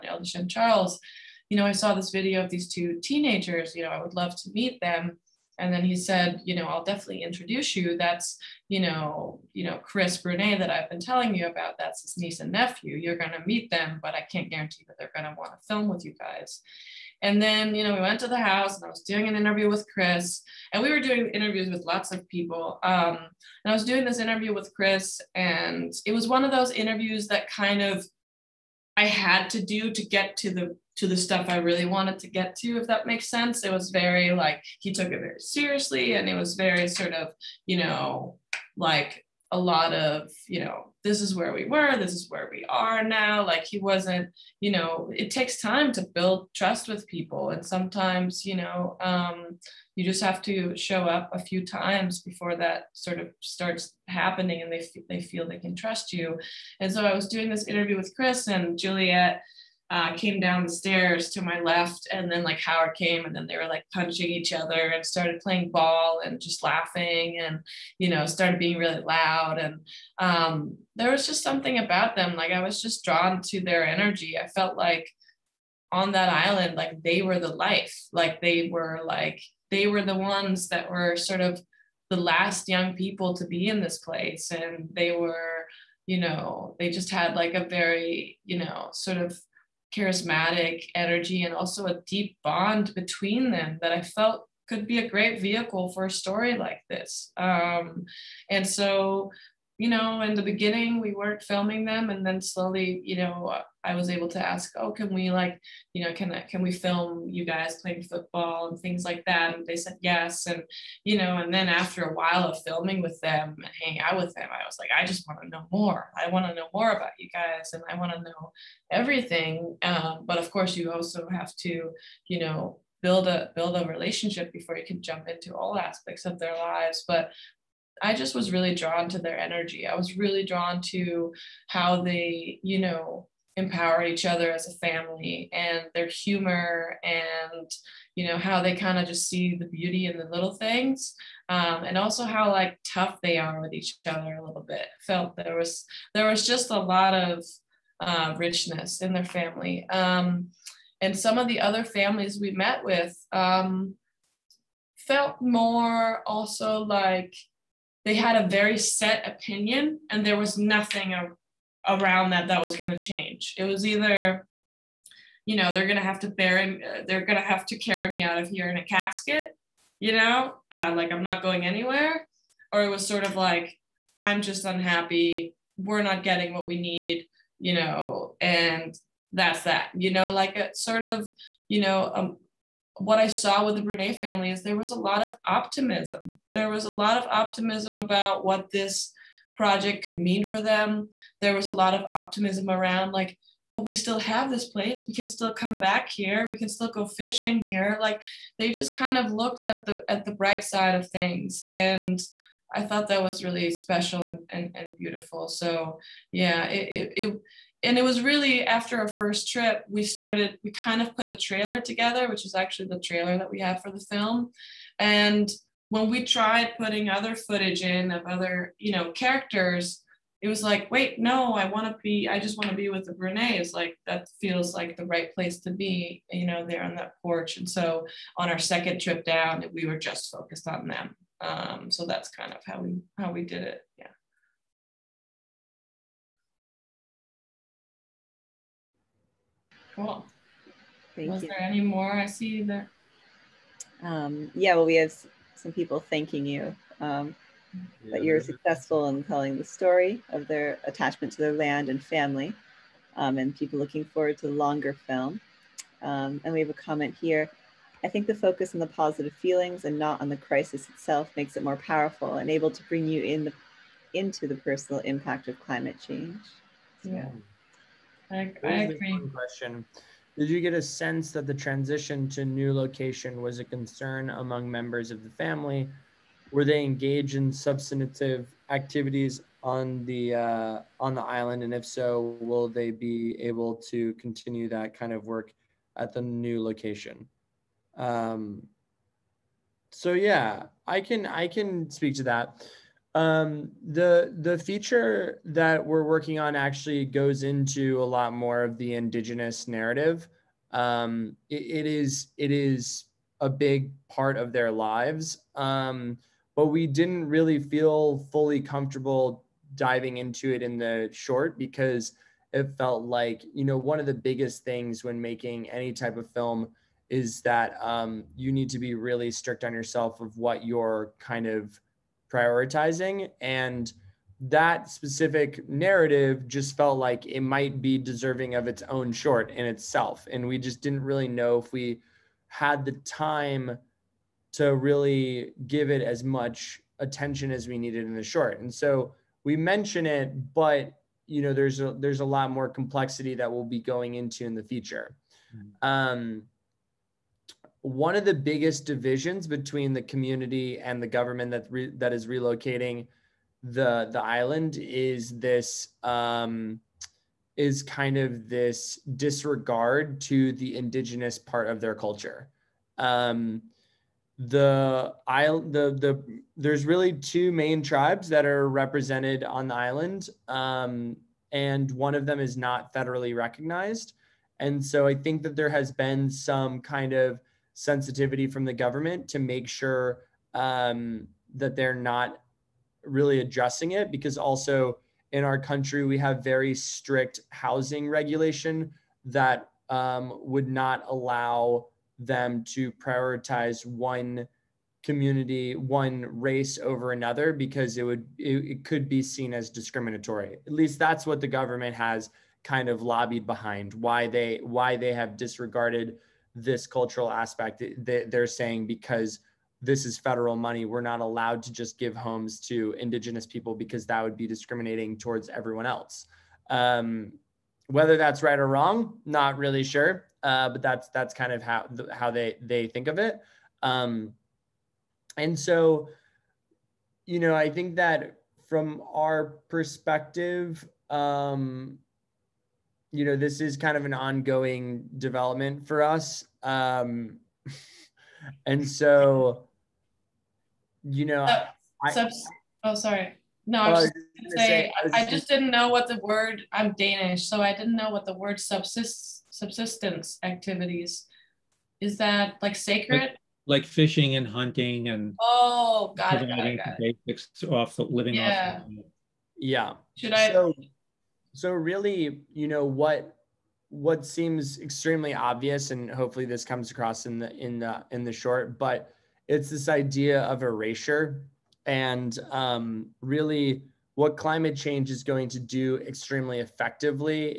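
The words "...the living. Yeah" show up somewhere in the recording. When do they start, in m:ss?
7:37.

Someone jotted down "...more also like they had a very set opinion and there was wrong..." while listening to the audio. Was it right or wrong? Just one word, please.
wrong.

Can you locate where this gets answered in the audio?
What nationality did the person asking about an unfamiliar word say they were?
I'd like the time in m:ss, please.
7:26.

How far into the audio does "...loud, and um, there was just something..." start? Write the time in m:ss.
1:09.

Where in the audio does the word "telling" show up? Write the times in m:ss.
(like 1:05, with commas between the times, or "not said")
0:10, 4:09.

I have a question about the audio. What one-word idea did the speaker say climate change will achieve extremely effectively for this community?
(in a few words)
erasure.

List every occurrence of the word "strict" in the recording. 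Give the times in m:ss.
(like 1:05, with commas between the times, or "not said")
5:19, 6:26.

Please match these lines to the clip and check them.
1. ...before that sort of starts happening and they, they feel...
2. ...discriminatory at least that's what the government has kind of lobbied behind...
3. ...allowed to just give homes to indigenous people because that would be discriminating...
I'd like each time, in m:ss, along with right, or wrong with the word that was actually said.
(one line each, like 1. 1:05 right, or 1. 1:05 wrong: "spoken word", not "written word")
1. 0:52 right
2. 6:39 right
3. 6:51 right.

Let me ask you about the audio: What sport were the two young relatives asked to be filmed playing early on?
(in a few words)
football.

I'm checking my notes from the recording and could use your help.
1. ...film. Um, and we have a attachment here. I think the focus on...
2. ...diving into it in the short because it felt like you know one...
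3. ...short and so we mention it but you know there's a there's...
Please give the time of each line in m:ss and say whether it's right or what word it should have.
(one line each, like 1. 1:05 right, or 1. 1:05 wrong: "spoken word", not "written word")
1. 4:15 wrong: "comment", not "attachment"
2. 5:09 right
3. 5:38 right.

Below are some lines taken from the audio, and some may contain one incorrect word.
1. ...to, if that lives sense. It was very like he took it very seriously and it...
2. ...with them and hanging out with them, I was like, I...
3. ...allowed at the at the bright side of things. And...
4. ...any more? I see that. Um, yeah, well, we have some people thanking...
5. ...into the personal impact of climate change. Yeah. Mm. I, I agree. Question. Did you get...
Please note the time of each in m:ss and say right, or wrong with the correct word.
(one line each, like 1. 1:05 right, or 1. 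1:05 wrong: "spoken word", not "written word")
1. 0:32 wrong: "makes", not "lives"
2. 1:53 right
3. 3:19 wrong: "looked", not "allowed"
4. 4:01 right
5. 4:24 right.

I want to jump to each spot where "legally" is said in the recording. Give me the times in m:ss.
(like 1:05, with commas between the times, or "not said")
not said.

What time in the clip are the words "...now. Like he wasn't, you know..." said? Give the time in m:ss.
0:43.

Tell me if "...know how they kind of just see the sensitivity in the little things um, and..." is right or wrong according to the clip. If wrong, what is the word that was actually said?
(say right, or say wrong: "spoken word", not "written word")
wrong: "beauty", not "sensitivity".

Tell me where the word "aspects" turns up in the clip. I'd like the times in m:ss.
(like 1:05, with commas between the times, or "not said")
2:05, 6:47.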